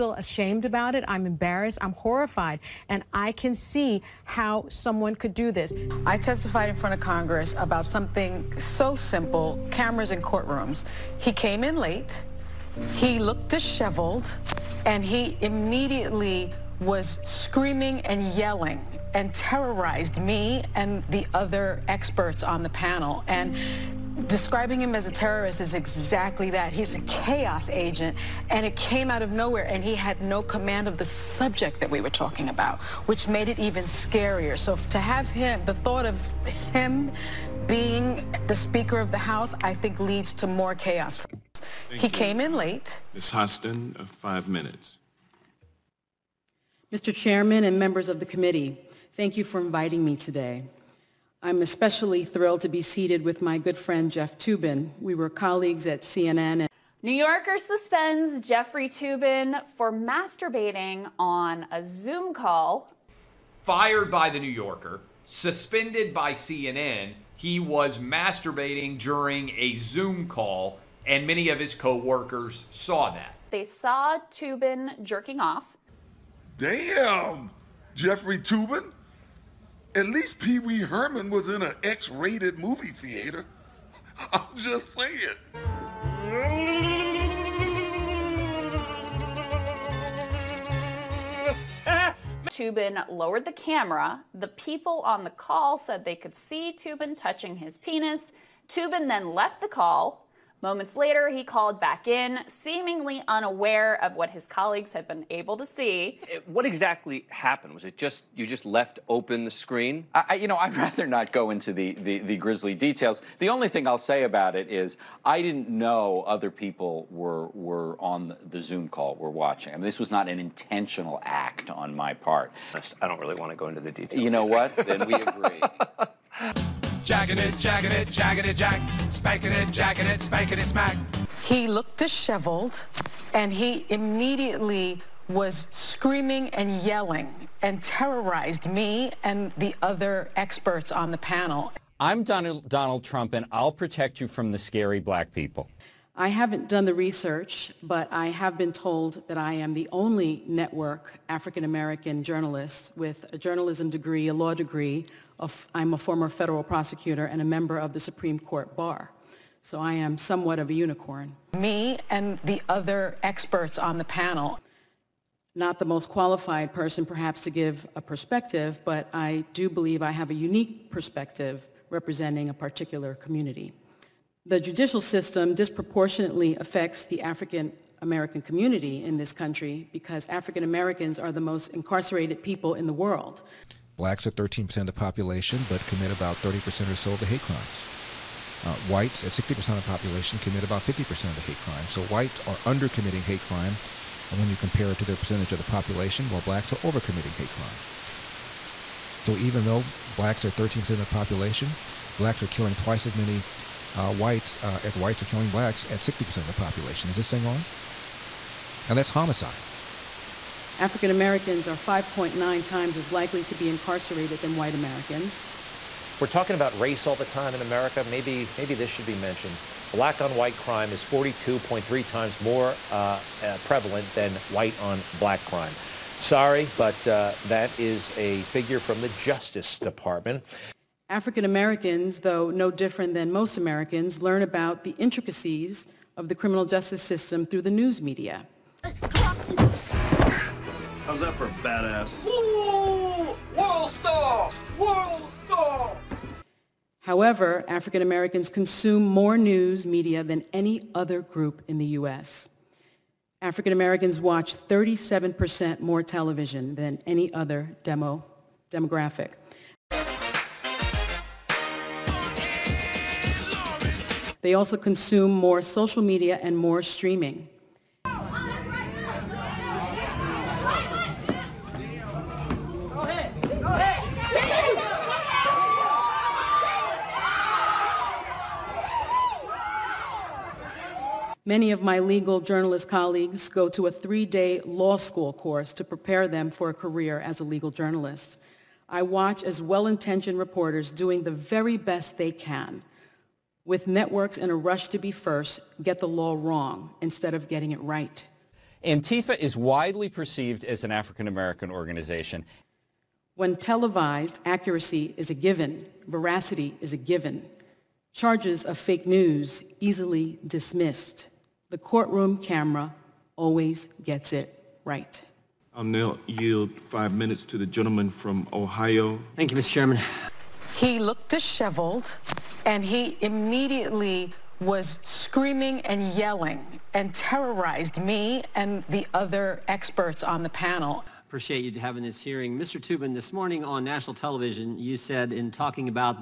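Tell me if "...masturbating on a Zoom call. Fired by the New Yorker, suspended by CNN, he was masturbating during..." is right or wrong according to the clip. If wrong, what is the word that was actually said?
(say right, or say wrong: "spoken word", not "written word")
right.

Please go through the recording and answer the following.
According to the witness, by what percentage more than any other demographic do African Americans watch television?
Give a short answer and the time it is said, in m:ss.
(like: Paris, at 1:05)
37%, at 4:14.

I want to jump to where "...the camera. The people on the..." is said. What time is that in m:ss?
1:33.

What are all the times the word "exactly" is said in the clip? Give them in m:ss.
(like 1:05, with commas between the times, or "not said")
0:25, 1:46.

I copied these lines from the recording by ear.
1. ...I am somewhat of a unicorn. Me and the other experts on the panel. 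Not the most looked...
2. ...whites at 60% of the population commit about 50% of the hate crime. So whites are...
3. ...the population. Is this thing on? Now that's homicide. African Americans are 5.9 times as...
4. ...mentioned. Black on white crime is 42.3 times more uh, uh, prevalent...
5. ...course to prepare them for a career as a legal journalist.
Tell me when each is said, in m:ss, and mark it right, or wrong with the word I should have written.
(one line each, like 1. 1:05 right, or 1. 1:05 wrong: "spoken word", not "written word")
1. 2:39 wrong: "qualified", not "looked"
2. 3:08 right
3. 3:26 right
4. 3:39 right
5. 4:45 right.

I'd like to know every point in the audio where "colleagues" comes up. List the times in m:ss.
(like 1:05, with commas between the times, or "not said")
0:55, 1:44, 4:42.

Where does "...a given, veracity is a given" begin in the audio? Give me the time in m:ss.
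5:05.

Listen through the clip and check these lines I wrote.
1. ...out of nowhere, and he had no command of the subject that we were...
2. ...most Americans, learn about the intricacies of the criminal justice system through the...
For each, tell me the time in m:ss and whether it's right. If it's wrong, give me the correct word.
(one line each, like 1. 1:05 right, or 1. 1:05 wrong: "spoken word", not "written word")
1. 0:29 right
2. 3:53 right.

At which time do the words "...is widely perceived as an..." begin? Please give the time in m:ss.
4:59.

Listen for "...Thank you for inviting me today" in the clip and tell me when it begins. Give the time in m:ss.
0:49.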